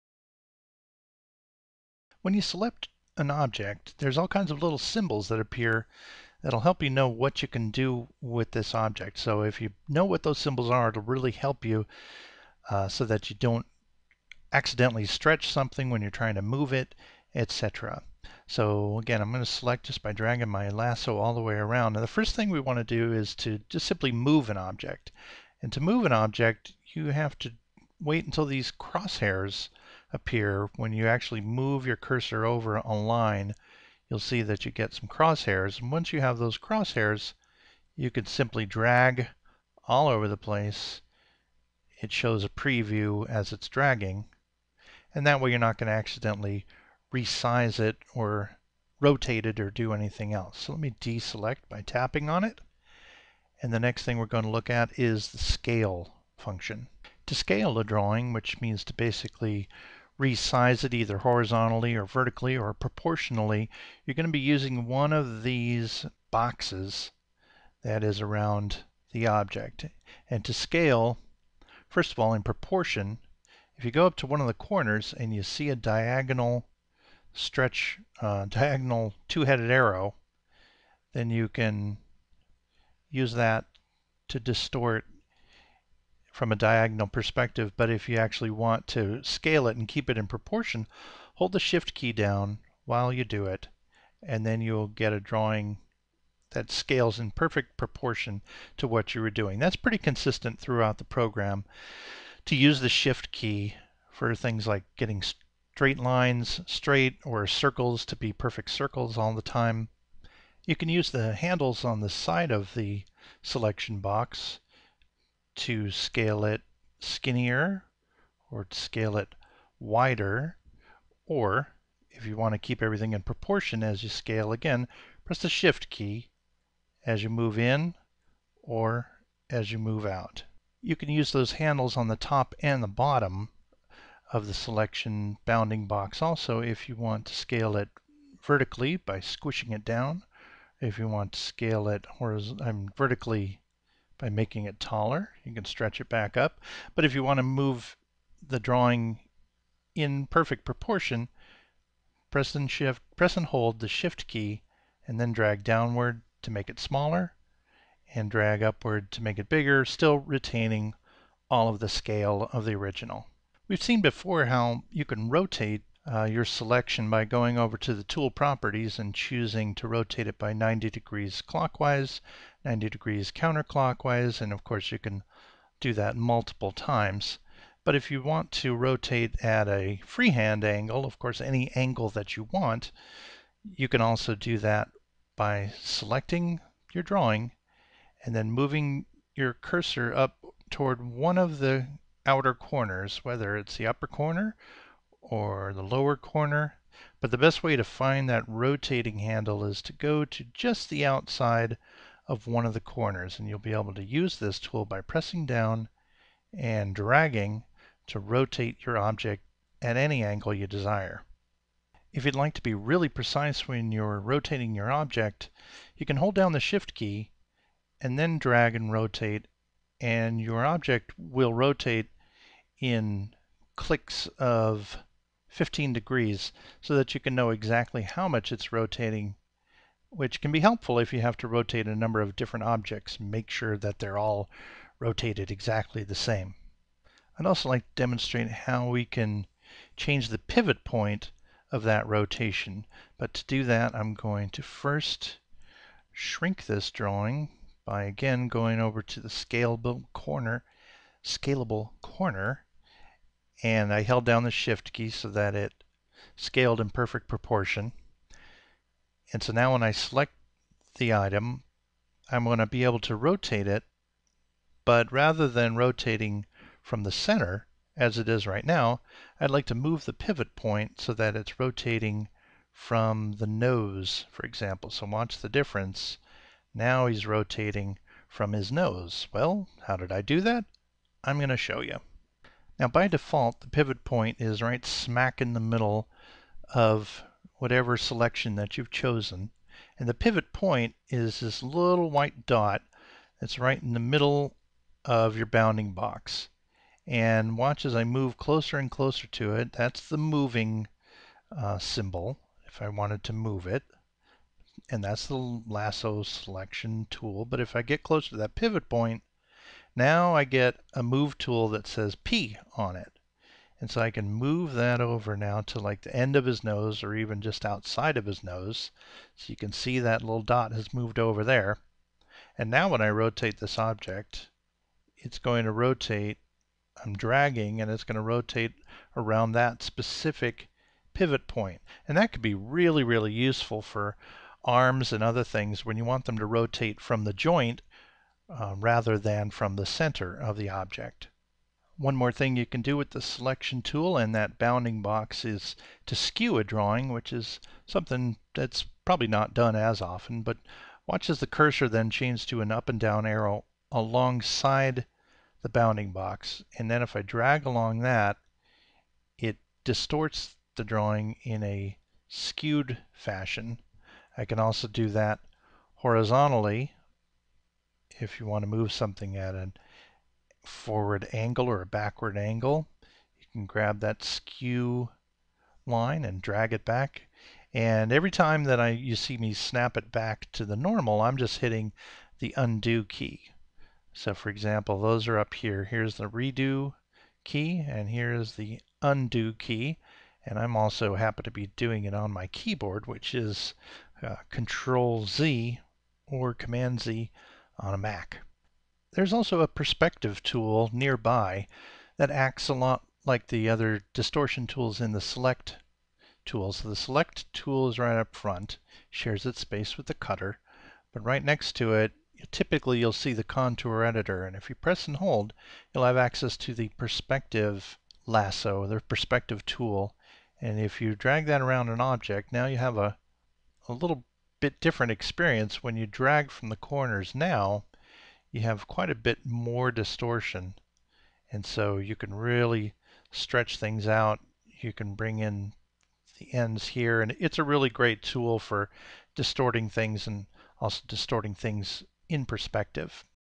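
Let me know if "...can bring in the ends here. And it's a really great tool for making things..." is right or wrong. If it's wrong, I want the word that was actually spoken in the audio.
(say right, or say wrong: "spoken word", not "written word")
wrong: "distorting", not "making".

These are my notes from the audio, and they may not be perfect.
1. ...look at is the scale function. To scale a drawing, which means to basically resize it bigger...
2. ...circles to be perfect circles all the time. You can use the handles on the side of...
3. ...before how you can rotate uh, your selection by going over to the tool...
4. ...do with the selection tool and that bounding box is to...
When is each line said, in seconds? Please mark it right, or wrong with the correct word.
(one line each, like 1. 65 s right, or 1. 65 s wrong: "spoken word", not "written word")
1. 54 s wrong: "either", not "bigger"
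2. 107 s right
3. 164 s right
4. 342 s right.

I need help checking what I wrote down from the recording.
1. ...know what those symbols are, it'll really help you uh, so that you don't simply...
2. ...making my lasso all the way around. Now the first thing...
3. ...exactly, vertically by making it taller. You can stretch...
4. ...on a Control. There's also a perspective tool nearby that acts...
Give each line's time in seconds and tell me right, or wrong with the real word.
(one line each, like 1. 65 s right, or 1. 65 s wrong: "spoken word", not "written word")
1. 9 s wrong: "accidentally", not "simply"
2. 20 s wrong: "dragging", not "making"
3. 142 s wrong: "horizontally", not "exactly"
4. 397 s wrong: "Mac", not "Control".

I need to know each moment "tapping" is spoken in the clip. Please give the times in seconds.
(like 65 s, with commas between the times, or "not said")
51 s.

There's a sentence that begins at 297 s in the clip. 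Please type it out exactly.
And watch as I move closer and closer to it.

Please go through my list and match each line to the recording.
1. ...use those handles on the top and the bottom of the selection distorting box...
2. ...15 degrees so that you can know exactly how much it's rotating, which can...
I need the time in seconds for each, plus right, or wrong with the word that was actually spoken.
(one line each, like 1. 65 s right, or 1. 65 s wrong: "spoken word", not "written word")
1. 131 s wrong: "bounding", not "distorting"
2. 225 s right.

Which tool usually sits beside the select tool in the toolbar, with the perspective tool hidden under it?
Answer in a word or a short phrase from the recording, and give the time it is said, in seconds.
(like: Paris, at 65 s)
Contour editor, at 413 s.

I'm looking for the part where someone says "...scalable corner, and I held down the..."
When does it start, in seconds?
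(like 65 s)
251 s.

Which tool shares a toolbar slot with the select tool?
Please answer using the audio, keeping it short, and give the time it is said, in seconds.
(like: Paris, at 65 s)
Cutter, at 410 s.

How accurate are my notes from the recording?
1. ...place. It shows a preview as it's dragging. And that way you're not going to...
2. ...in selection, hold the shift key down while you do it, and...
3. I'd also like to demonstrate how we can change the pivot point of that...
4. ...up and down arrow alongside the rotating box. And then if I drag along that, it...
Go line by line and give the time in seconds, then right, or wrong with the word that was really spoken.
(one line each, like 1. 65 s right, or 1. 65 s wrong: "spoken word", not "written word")
1. 40 s right
2. 90 s wrong: "proportion", not "selection"
3. 237 s right
4. 352 s wrong: "bounding", not "rotating".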